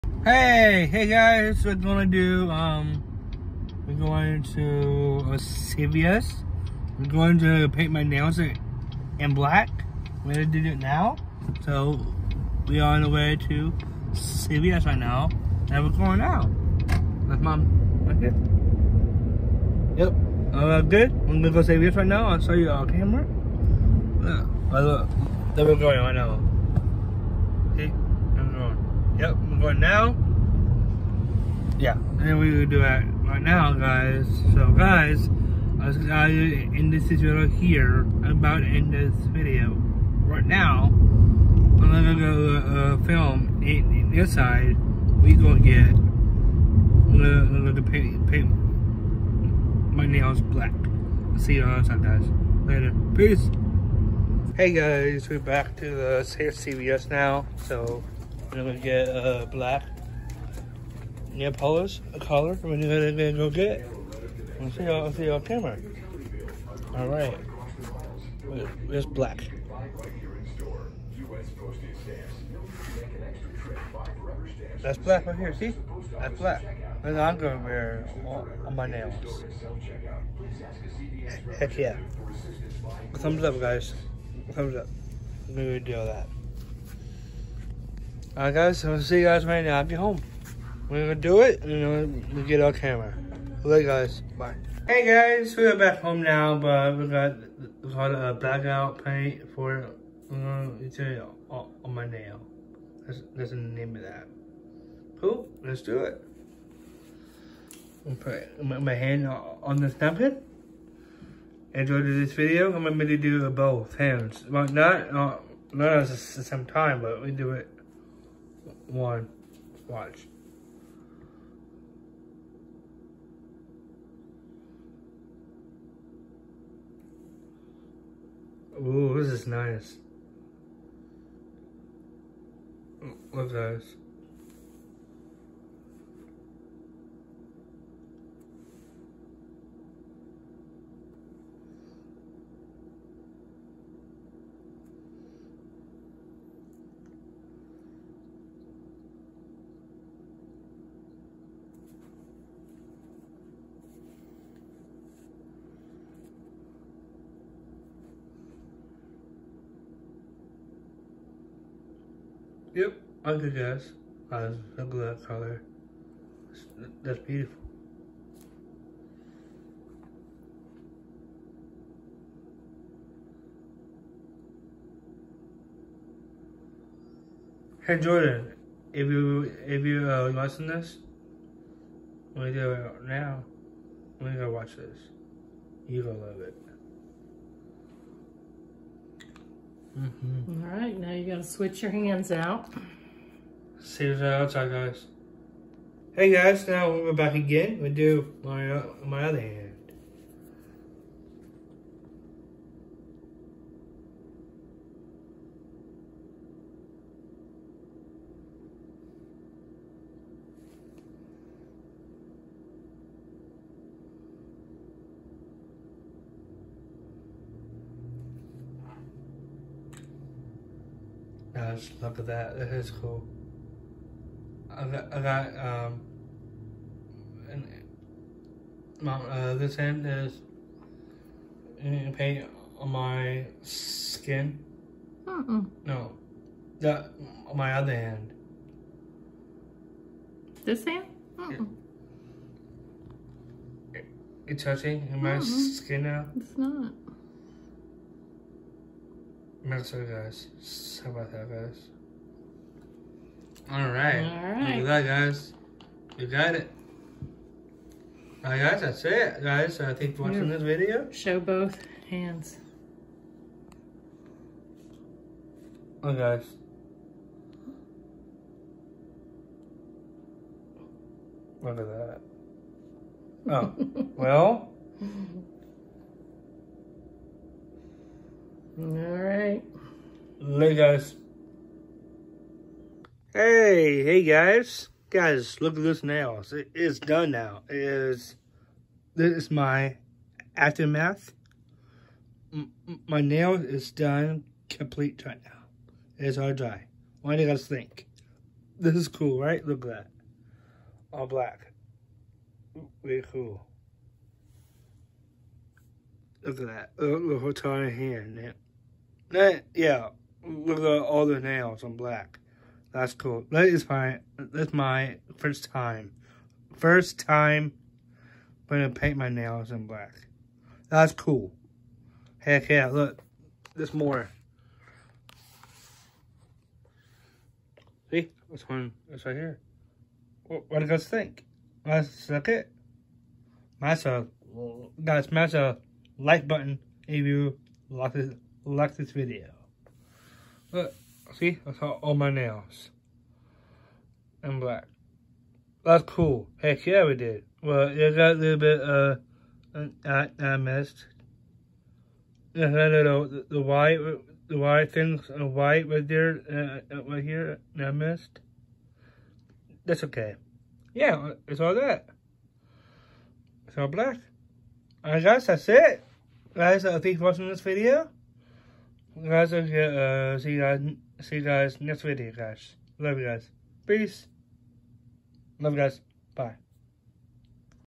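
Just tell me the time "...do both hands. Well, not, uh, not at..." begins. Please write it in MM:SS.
01:53.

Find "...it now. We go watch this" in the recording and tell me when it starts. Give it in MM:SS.
03:02.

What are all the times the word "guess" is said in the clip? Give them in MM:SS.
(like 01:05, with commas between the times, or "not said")
02:43, 06:05.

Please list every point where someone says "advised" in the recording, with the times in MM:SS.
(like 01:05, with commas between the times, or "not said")
not said.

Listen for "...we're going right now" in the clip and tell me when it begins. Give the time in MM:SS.
00:25.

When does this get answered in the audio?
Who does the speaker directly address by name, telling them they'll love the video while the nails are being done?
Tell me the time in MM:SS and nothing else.
02:57.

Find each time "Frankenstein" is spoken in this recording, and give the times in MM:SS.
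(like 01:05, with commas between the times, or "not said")
not said.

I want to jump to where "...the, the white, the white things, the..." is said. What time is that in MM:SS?
05:53.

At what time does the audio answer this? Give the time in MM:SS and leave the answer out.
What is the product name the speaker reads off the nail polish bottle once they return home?
01:38.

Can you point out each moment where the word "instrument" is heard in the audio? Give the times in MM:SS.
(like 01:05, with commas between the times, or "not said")
not said.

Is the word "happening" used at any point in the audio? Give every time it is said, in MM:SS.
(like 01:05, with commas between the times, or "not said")
not said.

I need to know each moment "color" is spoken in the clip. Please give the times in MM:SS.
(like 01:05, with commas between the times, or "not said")
01:02, 02:45.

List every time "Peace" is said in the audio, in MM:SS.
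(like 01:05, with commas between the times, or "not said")
00:53, 06:13.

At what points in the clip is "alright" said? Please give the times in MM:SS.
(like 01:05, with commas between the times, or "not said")
01:07, 01:28.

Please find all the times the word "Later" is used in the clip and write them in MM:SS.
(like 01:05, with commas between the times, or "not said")
00:52, 01:33, 04:40.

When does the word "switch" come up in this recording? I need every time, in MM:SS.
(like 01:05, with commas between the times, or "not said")
03:11.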